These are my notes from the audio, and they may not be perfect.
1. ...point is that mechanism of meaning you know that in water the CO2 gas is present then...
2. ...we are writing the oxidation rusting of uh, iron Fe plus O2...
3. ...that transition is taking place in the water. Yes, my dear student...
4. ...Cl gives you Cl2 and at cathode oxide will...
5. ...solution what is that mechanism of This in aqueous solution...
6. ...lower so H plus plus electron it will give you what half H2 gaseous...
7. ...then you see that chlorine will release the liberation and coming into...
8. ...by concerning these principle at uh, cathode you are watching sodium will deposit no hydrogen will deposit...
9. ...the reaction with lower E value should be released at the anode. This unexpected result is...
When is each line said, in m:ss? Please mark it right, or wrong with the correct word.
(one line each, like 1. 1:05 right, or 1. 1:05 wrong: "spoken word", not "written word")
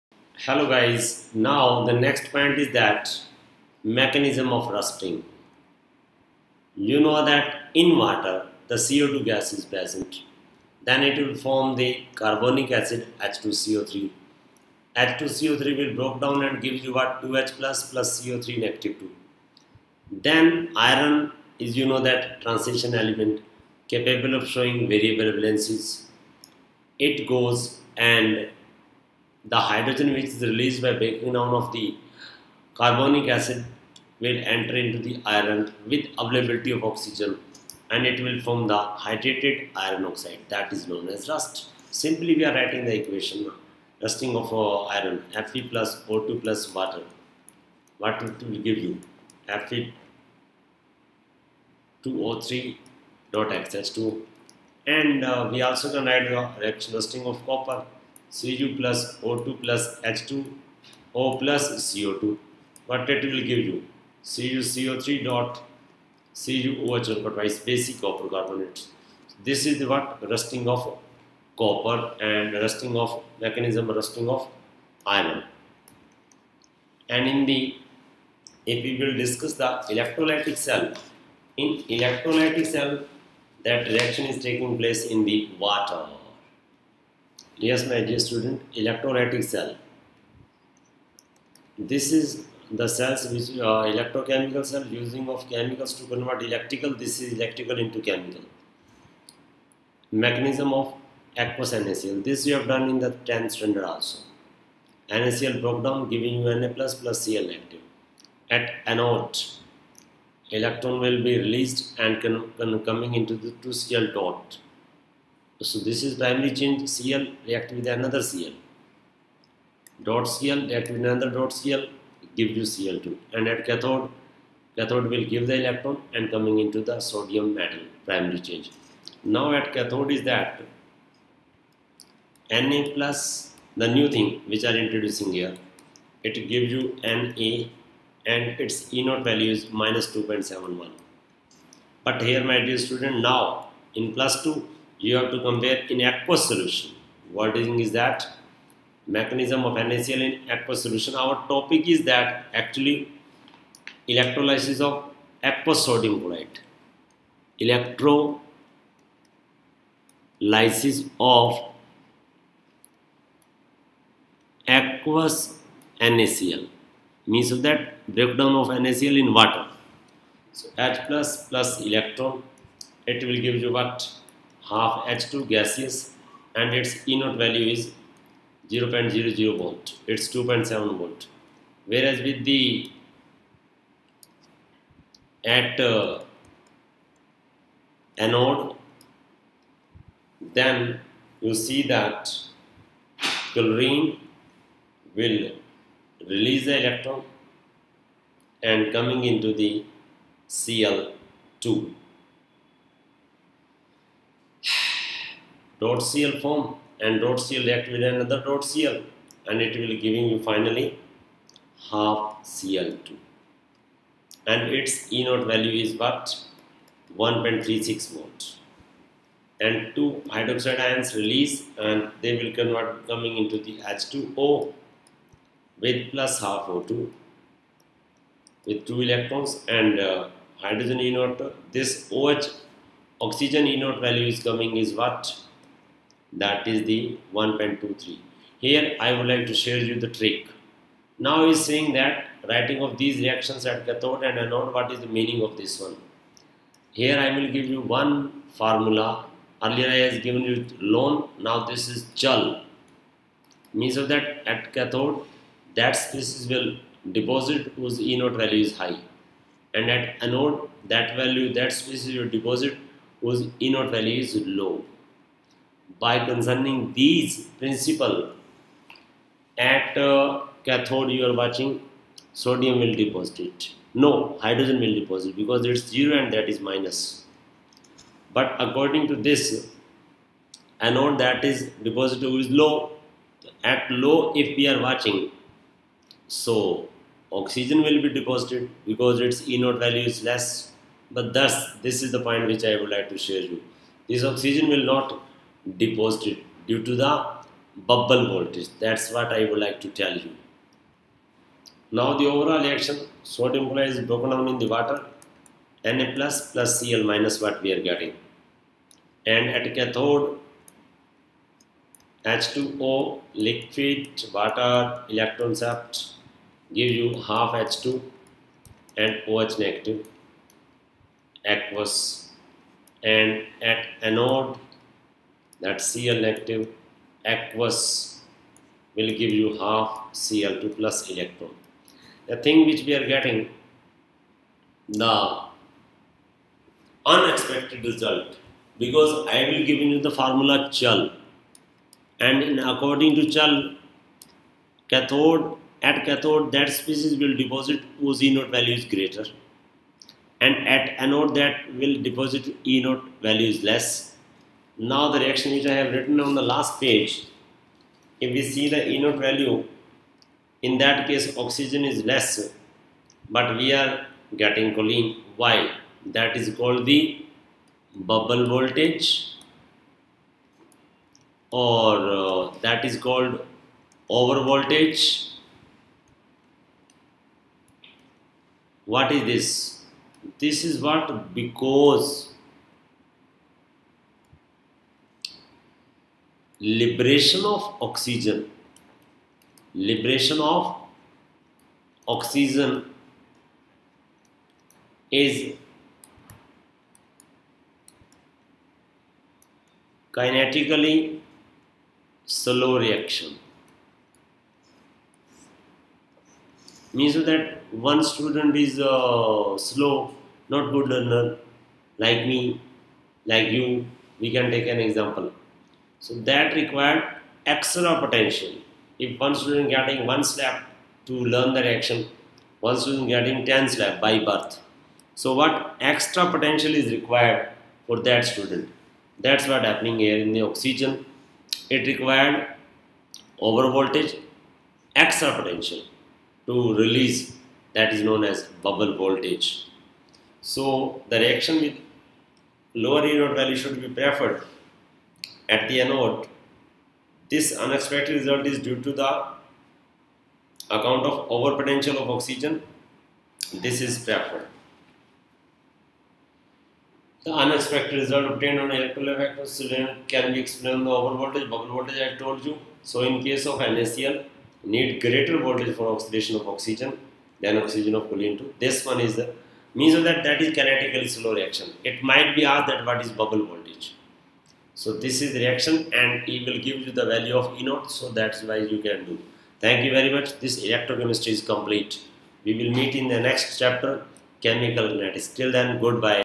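1. 0:02 wrong: "rusting", not "meaning"
2. 0:42 wrong: "equation", not "oxidation"
3. 1:23 wrong: "reaction", not "transition"
4. 2:01 wrong: "cathode", not "oxide"
5. 2:26 wrong: "NaCl", not "This"
6. 2:49 wrong: "water", not "lower"
7. 3:10 wrong: "electron", not "liberation"
8. 4:25 right
9. 7:21 wrong: "preferred", not "released".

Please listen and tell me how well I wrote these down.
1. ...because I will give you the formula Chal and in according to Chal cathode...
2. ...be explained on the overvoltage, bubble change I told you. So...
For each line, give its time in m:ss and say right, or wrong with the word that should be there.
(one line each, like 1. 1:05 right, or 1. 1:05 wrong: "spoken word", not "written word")
1. 5:38 right
2. 7:40 wrong: "voltage", not "change".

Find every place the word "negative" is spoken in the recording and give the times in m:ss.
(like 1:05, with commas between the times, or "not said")
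0:18, 5:19, 5:26.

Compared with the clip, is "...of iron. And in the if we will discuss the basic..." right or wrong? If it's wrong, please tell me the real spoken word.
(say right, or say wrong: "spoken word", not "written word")
wrong: "electrolytic", not "basic".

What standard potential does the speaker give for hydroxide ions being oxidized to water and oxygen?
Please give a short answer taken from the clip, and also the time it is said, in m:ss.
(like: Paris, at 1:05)
1.23, at 3:57.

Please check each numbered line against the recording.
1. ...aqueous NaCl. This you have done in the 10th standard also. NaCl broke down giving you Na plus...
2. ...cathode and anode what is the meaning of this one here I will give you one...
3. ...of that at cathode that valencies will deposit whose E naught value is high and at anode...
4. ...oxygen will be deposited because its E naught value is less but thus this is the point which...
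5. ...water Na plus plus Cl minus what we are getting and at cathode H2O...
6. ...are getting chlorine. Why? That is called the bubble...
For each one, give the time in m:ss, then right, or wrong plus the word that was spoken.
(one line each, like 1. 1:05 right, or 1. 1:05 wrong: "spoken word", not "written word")
1. 1:41 right
2. 4:03 right
3. 4:13 wrong: "species", not "valencies"
4. 4:47 right
5. 5:04 right
6. 6:03 right.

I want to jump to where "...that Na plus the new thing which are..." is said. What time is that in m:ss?
2:10.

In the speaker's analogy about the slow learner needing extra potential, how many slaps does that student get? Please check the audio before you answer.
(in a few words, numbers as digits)
10.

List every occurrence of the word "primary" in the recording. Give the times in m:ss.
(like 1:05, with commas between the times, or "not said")
1:56, 2:08.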